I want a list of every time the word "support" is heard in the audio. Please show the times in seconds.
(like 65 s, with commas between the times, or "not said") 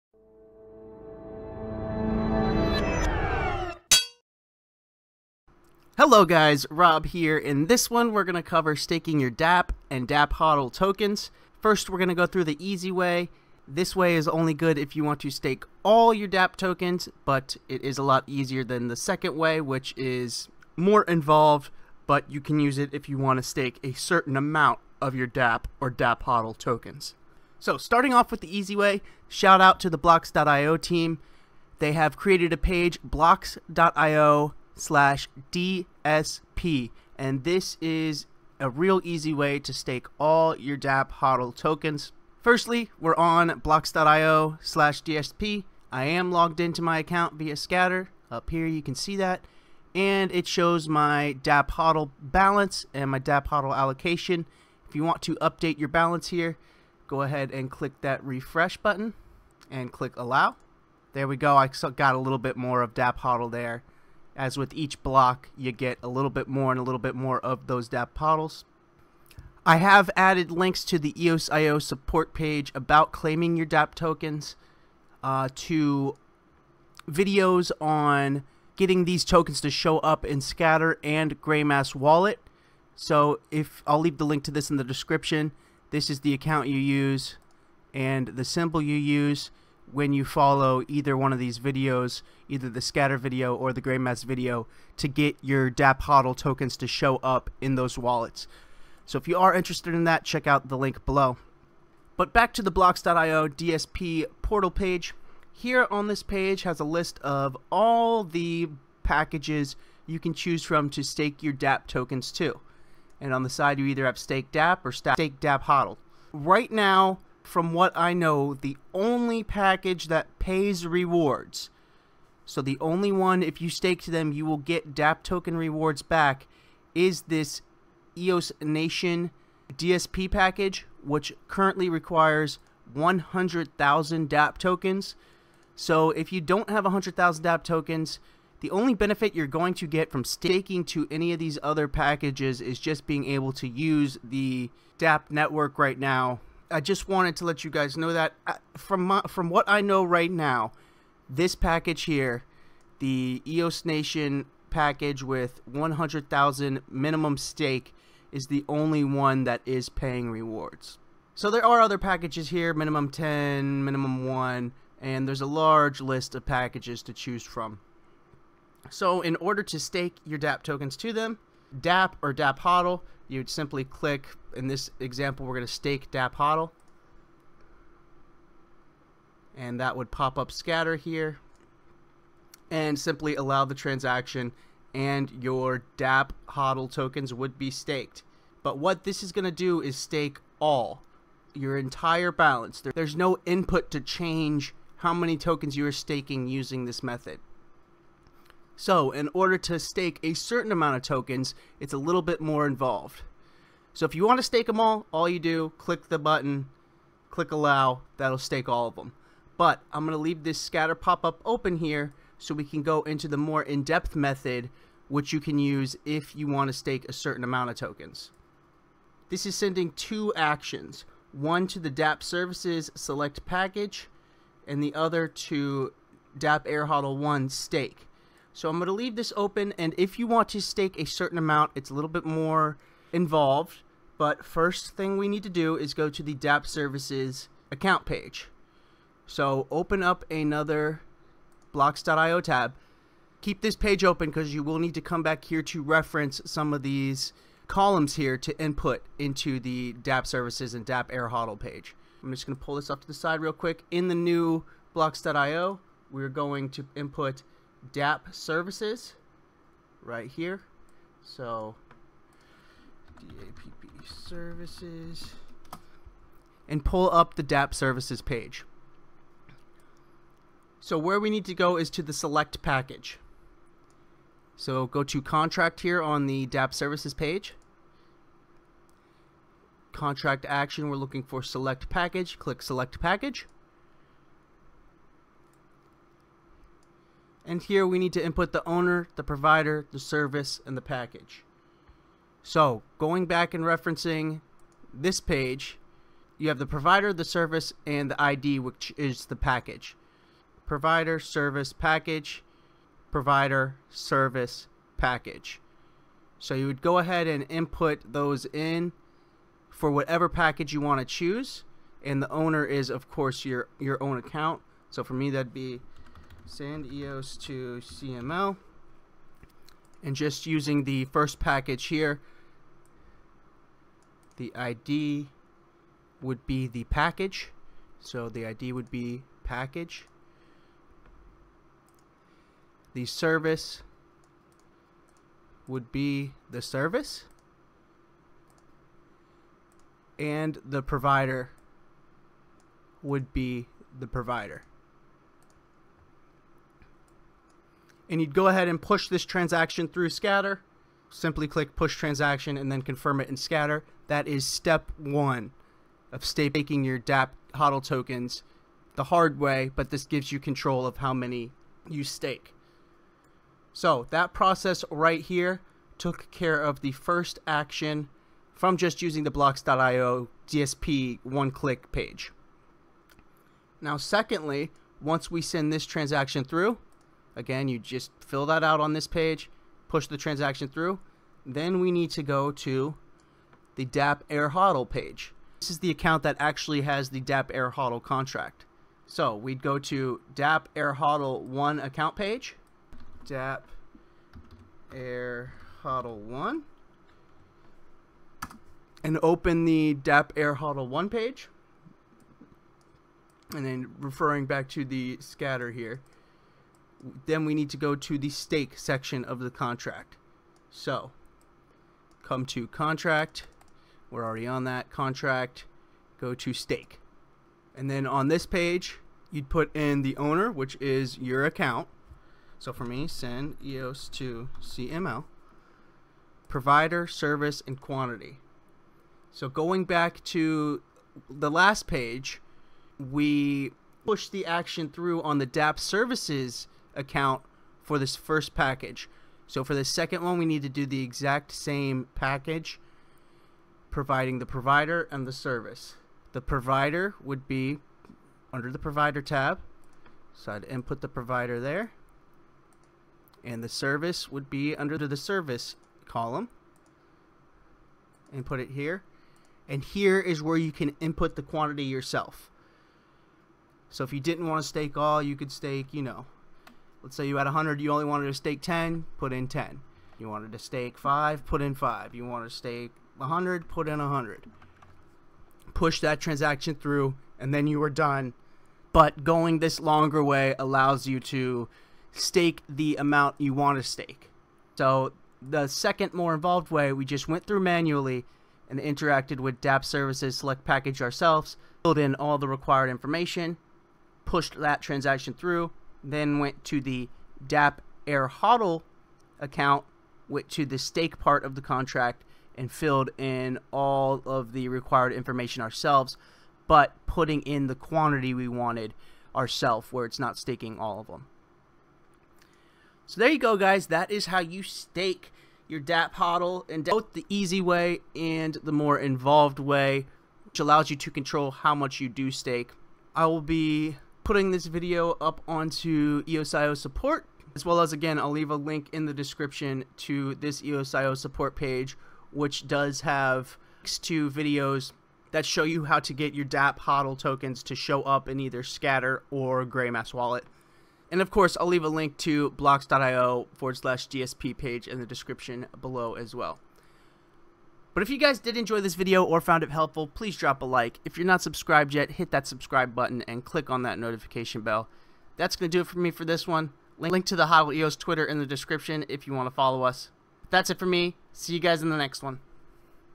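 71 s, 526 s, 531 s.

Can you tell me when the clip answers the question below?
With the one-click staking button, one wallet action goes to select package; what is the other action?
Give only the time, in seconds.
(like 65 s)
226 s.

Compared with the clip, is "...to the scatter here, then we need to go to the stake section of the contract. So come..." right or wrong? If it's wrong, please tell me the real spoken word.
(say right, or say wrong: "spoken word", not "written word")
right.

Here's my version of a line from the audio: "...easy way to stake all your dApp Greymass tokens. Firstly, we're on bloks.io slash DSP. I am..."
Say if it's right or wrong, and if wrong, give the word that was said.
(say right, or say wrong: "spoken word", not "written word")
wrong: "HODL", not "Greymass".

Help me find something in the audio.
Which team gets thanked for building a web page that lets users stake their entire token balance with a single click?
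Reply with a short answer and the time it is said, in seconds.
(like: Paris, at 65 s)
bloks.io team, at 29 s.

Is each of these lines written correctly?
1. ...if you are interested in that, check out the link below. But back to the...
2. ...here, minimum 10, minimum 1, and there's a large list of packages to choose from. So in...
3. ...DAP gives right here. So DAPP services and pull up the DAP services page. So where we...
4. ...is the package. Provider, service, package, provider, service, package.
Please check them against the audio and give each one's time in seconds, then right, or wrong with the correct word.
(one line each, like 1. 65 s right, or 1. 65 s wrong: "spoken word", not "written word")
1. 99 s right
2. 162 s right
3. 257 s wrong: "services", not "gives"
4. 298 s right.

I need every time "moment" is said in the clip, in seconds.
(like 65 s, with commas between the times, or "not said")
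not said.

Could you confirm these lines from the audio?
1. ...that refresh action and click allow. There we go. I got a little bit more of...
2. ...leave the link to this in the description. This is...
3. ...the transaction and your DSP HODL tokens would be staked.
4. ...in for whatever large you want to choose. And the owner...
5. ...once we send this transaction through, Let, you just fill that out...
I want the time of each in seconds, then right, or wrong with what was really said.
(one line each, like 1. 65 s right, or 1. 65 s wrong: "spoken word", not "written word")
1. 58 s wrong: "button", not "action"
2. 83 s right
3. 183 s wrong: "DAP", not "DSP"
4. 308 s wrong: "package", not "large"
5. 375 s wrong: "Again", not "Let".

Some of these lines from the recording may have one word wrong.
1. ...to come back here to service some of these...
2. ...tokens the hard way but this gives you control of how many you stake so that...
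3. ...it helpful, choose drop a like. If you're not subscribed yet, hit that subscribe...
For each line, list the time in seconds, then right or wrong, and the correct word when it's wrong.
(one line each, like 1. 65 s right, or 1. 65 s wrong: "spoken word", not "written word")
1. 244 s wrong: "reference", not "service"
2. 357 s right
3. 549 s wrong: "please", not "choose".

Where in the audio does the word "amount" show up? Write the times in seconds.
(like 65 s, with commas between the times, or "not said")
24 s, 200 s, 217 s, 231 s, 482 s.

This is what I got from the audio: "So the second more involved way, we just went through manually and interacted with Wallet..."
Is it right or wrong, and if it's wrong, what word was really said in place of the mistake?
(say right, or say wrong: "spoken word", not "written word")
wrong: "DAP", not "Wallet".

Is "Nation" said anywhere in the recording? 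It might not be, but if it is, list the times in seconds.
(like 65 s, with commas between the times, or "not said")
128 s, 153 s.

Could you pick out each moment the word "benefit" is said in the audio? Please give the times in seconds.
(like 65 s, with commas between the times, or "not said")
138 s.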